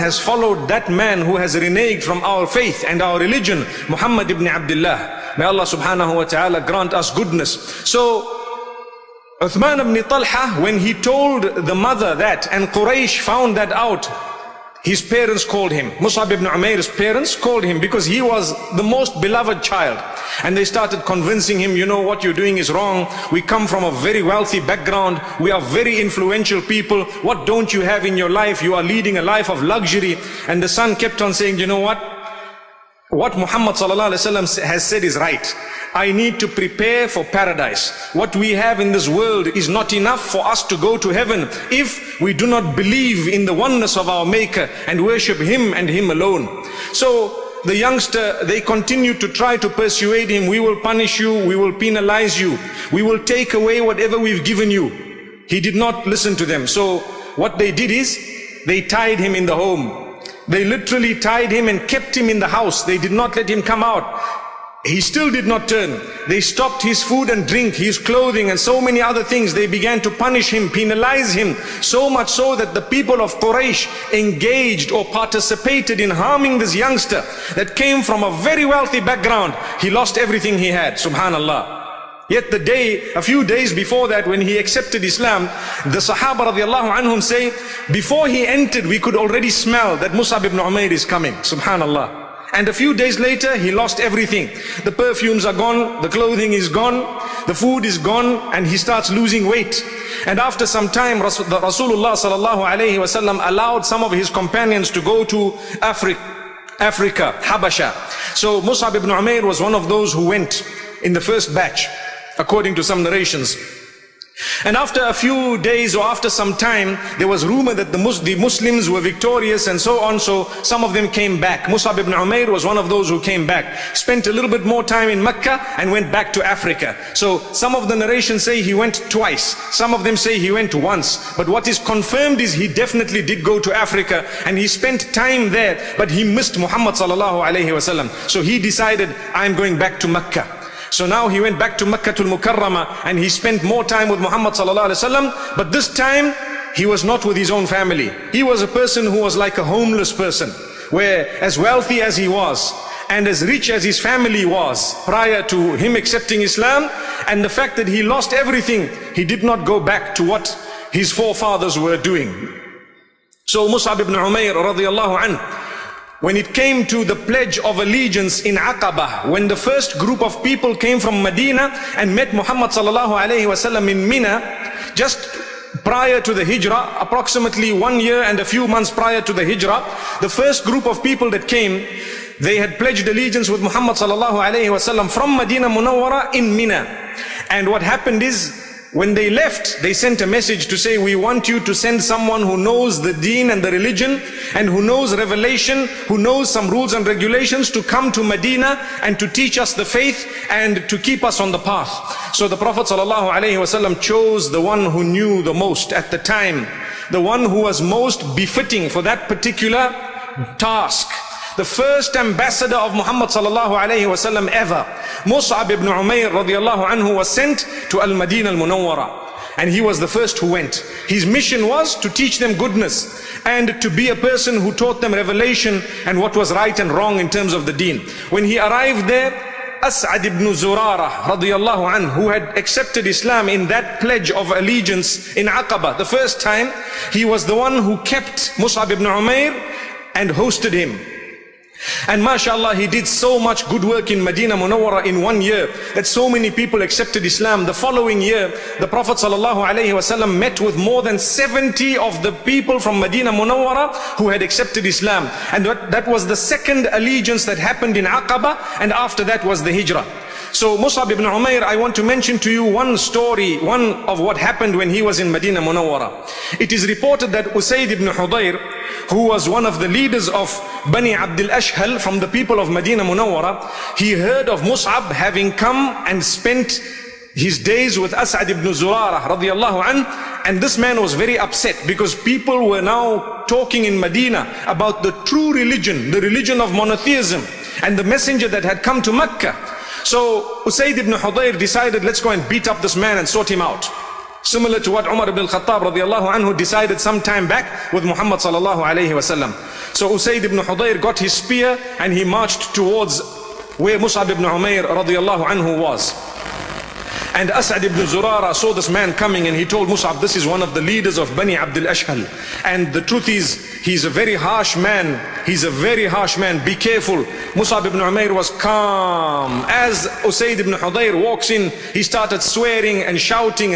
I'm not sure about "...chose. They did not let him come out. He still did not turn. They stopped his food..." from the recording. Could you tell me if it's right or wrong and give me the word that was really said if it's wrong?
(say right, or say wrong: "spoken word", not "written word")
wrong: "house", not "chose".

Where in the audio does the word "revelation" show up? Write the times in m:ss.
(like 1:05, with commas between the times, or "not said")
3:15, 3:45.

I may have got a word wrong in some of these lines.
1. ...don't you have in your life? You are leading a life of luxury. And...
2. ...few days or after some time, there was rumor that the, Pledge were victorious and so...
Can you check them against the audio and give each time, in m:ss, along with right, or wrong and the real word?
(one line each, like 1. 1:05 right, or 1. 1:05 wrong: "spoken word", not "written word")
1. 0:27 right
2. 1:55 wrong: "Muslims", not "Pledge".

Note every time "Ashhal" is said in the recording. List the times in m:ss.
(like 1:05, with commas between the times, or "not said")
4:31, 5:11.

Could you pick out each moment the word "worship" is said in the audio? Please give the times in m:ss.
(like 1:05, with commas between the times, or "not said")
0:45.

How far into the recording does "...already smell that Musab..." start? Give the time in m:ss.
1:29.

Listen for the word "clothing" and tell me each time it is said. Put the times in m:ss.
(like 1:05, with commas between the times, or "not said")
1:07, 1:36.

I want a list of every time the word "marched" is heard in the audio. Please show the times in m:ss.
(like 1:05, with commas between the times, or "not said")
5:02.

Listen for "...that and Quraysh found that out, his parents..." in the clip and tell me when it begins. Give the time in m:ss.
0:12.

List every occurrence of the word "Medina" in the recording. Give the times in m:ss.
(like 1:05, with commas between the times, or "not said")
2:51, 3:05, 3:18, 4:04, 4:12, 4:25, 4:32, 4:43.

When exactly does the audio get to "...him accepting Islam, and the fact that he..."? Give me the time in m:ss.
2:35.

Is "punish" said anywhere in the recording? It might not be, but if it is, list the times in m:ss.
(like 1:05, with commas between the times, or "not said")
0:50, 1:10.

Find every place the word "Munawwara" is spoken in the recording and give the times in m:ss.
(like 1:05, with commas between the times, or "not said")
3:05, 3:38, 4:04, 4:13, 4:25, 4:33.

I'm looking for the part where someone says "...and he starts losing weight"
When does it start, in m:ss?
1:38.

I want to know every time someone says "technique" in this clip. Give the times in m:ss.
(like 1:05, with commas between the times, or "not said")
not said.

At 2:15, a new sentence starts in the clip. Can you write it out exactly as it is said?
But he missed Muhammad sallallahu alayhi wasallam.